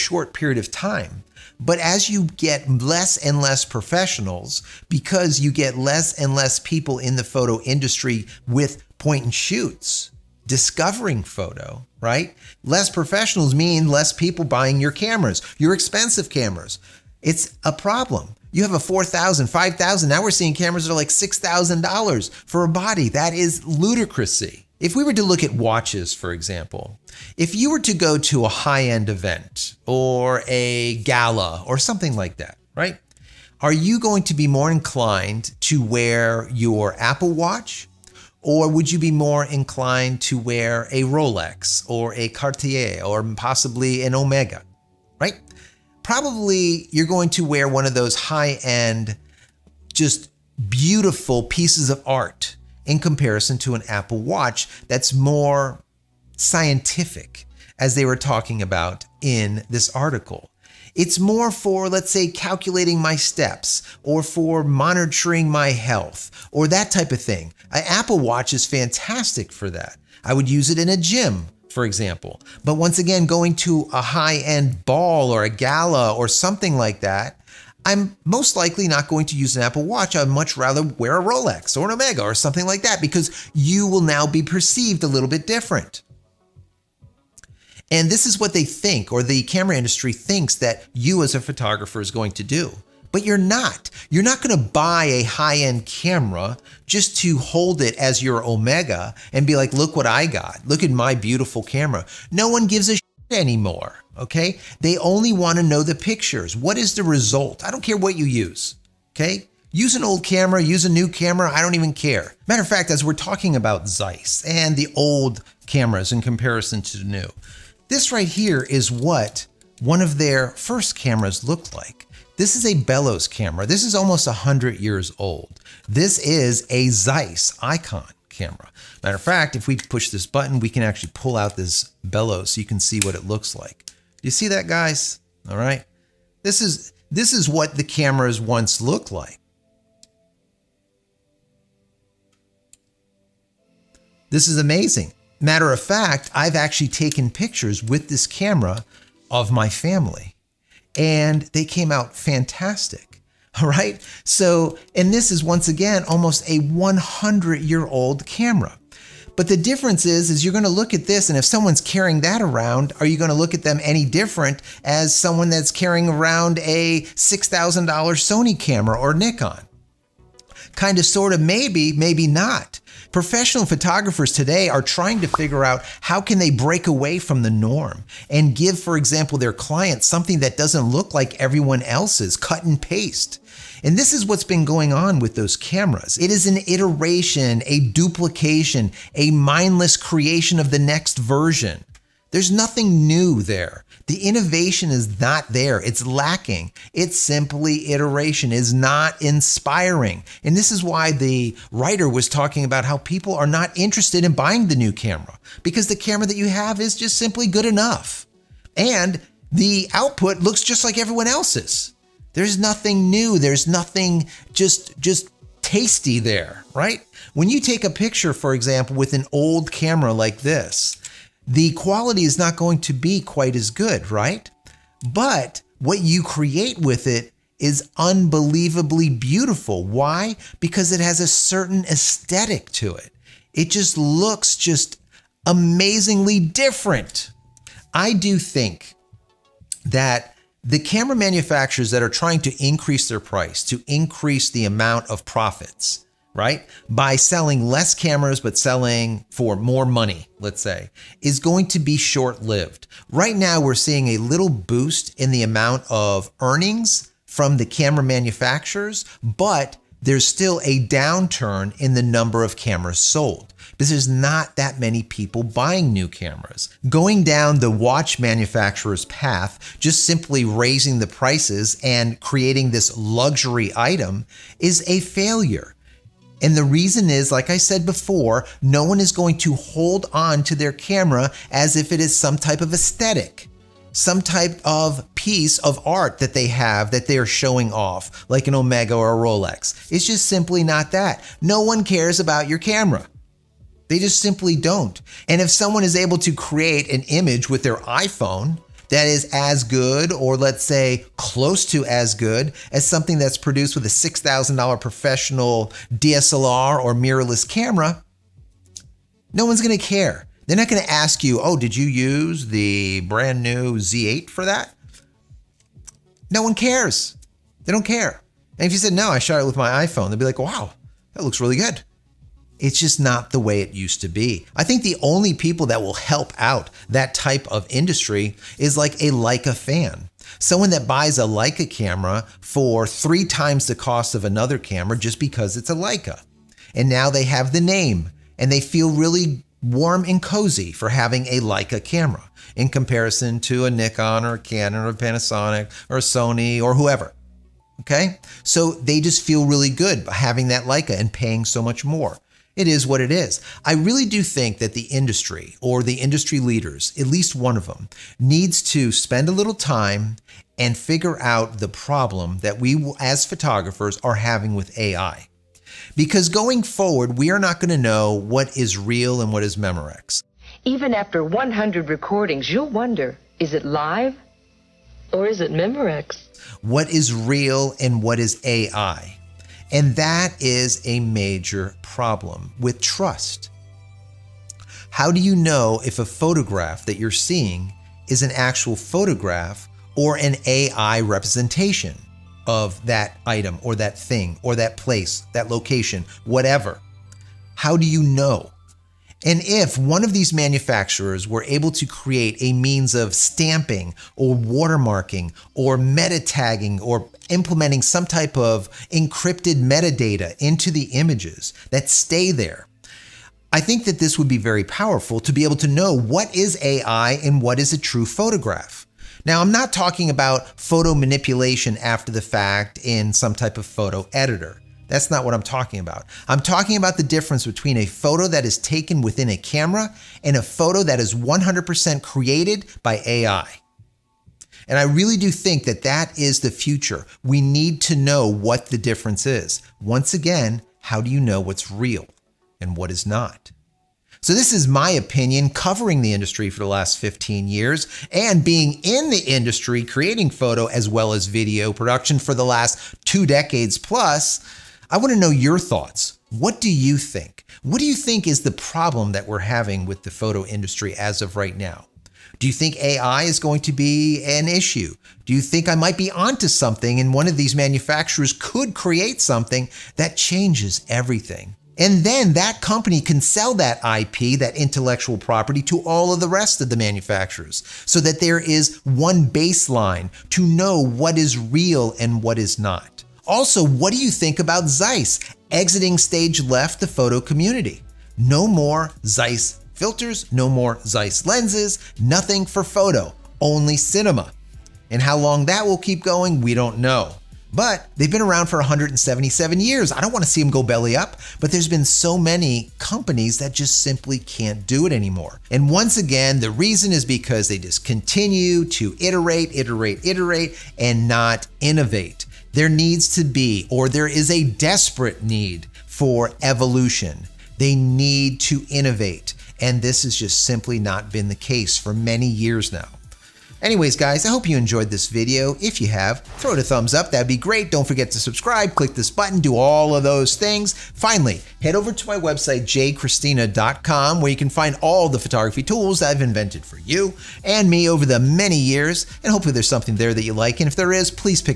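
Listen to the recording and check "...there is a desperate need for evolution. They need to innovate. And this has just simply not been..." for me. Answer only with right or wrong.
right.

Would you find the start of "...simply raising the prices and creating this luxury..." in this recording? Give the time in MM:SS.
04:30.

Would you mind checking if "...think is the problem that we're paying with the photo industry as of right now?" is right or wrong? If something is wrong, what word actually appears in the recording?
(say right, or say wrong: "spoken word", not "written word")
wrong: "having", not "paying".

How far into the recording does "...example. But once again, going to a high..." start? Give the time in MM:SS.
01:11.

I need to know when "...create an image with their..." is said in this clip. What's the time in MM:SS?
04:56.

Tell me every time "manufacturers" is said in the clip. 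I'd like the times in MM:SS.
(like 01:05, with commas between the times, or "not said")
04:01, 04:18, 04:28, 06:40, 07:47, 07:56.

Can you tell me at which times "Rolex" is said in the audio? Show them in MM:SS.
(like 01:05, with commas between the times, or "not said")
00:41, 01:21, 04:49.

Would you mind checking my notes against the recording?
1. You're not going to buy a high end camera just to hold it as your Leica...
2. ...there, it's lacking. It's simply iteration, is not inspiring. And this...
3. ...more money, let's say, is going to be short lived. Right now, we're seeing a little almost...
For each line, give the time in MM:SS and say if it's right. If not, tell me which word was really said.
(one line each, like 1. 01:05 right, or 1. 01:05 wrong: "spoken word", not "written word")
1. 01:34 wrong: "Omega", not "Leica"
2. 03:15 right
3. 04:09 wrong: "boost", not "almost".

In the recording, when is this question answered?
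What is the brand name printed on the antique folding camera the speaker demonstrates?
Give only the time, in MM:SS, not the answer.
02:06.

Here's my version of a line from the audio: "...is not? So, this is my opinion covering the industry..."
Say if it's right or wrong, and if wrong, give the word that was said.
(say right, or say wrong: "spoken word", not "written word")
right.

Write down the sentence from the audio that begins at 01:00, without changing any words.
It's more for, let's say, calculating my steps or for monitoring my health or that type of thing.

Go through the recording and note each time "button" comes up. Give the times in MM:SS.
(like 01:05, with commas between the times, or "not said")
02:10, 08:49.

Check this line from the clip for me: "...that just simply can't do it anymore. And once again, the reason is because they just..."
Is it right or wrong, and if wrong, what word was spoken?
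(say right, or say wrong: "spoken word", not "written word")
right.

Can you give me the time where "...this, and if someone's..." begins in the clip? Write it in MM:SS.
02:41.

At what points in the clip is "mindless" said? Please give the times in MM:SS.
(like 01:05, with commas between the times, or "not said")
03:09.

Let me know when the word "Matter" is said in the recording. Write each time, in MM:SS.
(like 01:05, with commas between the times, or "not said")
01:52, 02:09, 02:25.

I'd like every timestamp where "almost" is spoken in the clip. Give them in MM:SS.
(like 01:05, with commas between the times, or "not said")
02:03, 02:36.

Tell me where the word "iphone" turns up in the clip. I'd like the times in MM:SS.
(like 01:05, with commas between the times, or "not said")
04:57, 05:19.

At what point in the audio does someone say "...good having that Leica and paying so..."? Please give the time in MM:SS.
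05:49.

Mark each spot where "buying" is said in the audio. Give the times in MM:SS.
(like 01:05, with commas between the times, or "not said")
00:14, 03:24, 04:25.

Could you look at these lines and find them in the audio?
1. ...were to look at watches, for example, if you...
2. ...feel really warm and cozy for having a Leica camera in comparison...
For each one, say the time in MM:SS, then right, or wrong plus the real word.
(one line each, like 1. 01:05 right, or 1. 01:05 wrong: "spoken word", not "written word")
1. 00:25 right
2. 05:38 right.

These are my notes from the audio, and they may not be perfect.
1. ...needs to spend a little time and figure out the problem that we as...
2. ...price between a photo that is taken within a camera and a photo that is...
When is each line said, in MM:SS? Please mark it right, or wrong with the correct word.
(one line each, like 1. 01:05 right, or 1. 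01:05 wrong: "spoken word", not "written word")
1. 05:58 right
2. 07:07 wrong: "difference", not "price".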